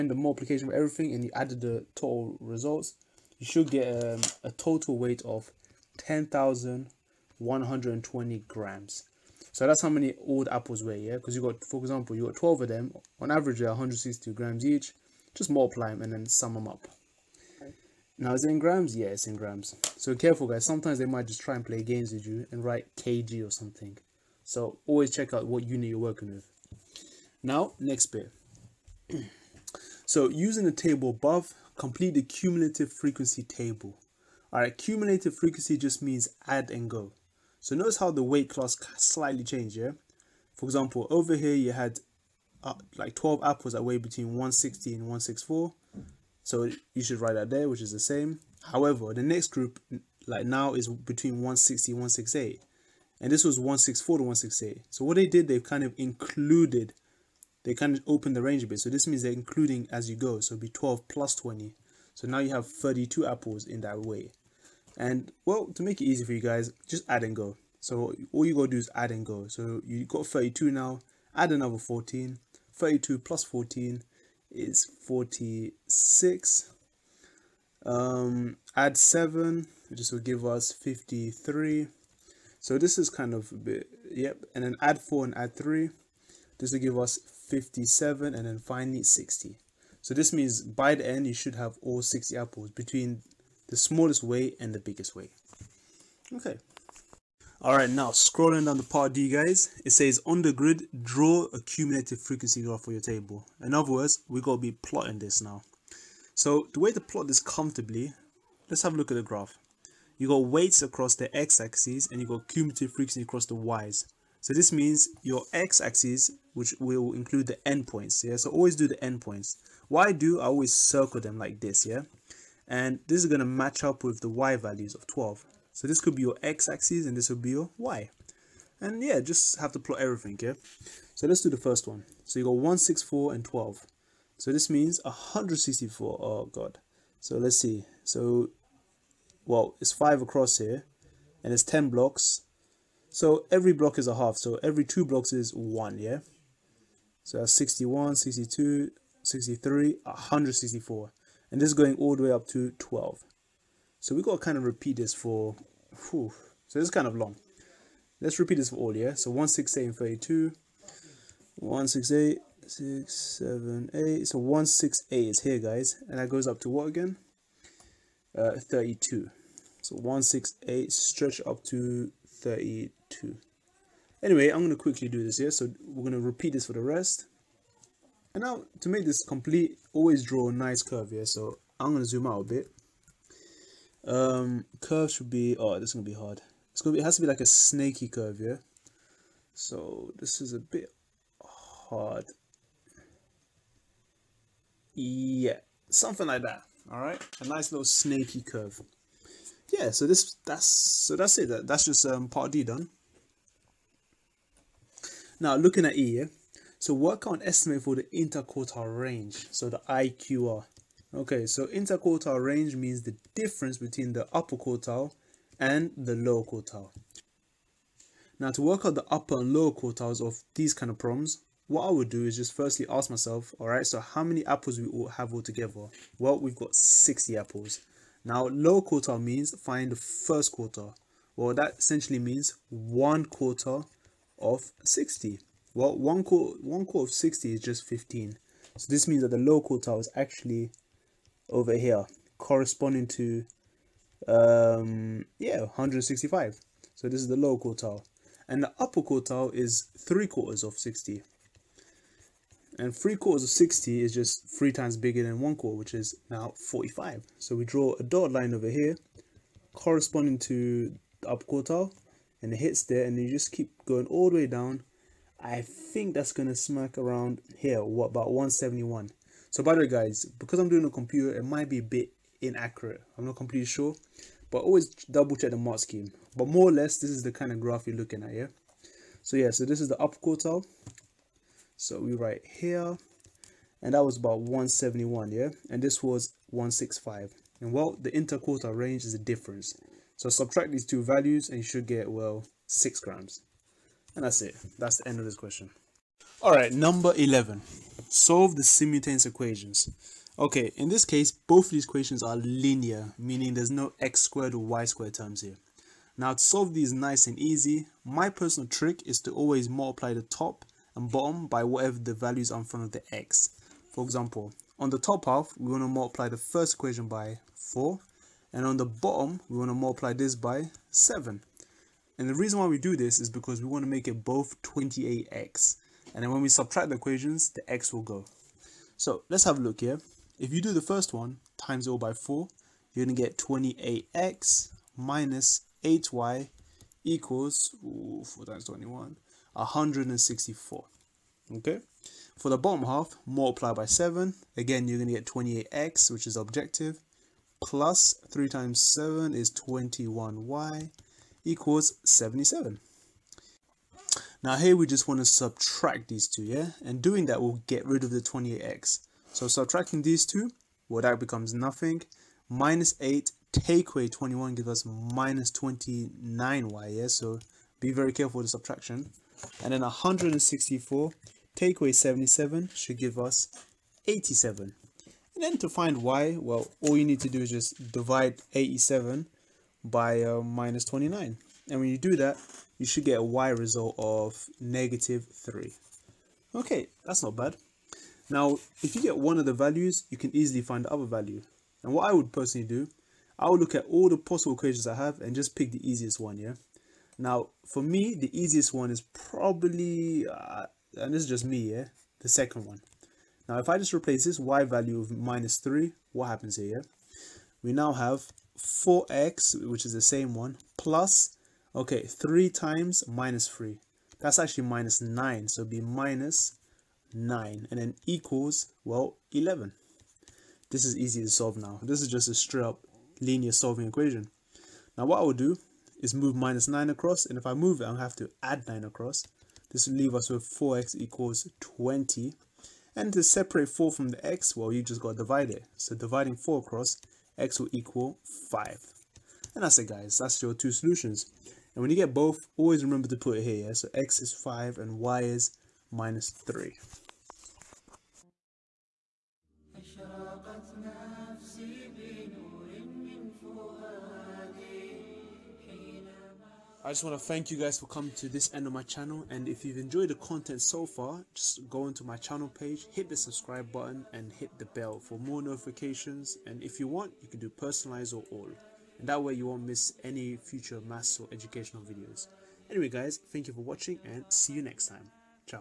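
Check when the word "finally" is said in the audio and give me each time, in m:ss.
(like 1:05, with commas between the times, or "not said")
1:28.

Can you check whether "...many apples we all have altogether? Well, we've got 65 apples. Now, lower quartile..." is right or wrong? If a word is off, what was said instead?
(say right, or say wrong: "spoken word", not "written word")
wrong: "60", not "65".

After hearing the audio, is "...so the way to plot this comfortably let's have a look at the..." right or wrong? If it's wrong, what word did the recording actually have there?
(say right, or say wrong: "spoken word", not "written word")
right.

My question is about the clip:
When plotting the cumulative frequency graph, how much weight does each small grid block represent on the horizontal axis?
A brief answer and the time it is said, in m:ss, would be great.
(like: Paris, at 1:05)
a half, at 2:24.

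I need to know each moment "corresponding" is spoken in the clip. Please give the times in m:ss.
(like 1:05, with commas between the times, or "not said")
4:02, 4:19.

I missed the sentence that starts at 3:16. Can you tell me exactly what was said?
All right, a nice little snaky curve.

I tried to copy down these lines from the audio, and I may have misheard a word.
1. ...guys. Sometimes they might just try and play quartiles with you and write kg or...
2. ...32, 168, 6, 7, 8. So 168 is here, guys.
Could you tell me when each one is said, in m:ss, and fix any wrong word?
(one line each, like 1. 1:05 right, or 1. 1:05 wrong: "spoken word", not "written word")
1. 0:20 wrong: "games", not "quartiles"
2. 2:39 right.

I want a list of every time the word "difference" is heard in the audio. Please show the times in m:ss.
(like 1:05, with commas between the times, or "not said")
3:33, 4:49.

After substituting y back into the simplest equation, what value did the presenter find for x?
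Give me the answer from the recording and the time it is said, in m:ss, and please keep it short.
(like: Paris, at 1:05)
5, at 7:17.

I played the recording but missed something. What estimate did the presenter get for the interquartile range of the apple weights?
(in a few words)
6 grams.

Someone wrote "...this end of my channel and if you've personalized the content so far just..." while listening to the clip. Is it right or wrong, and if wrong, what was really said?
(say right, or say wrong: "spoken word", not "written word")
wrong: "enjoyed", not "personalized".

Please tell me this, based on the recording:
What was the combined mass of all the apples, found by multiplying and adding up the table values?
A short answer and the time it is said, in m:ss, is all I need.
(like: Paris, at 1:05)
10,120 grams, at 0:05.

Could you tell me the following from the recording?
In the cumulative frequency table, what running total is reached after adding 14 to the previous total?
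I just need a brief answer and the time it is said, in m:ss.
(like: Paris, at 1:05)
46, at 1:15.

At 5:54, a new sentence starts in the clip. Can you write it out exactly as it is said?
Now here we just want to subtract these two, yeah?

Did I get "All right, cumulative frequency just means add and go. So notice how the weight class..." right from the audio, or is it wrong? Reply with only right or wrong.
right.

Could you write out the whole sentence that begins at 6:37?
Now, for me, the easiest one is probably, uh, and this is just me, yeah?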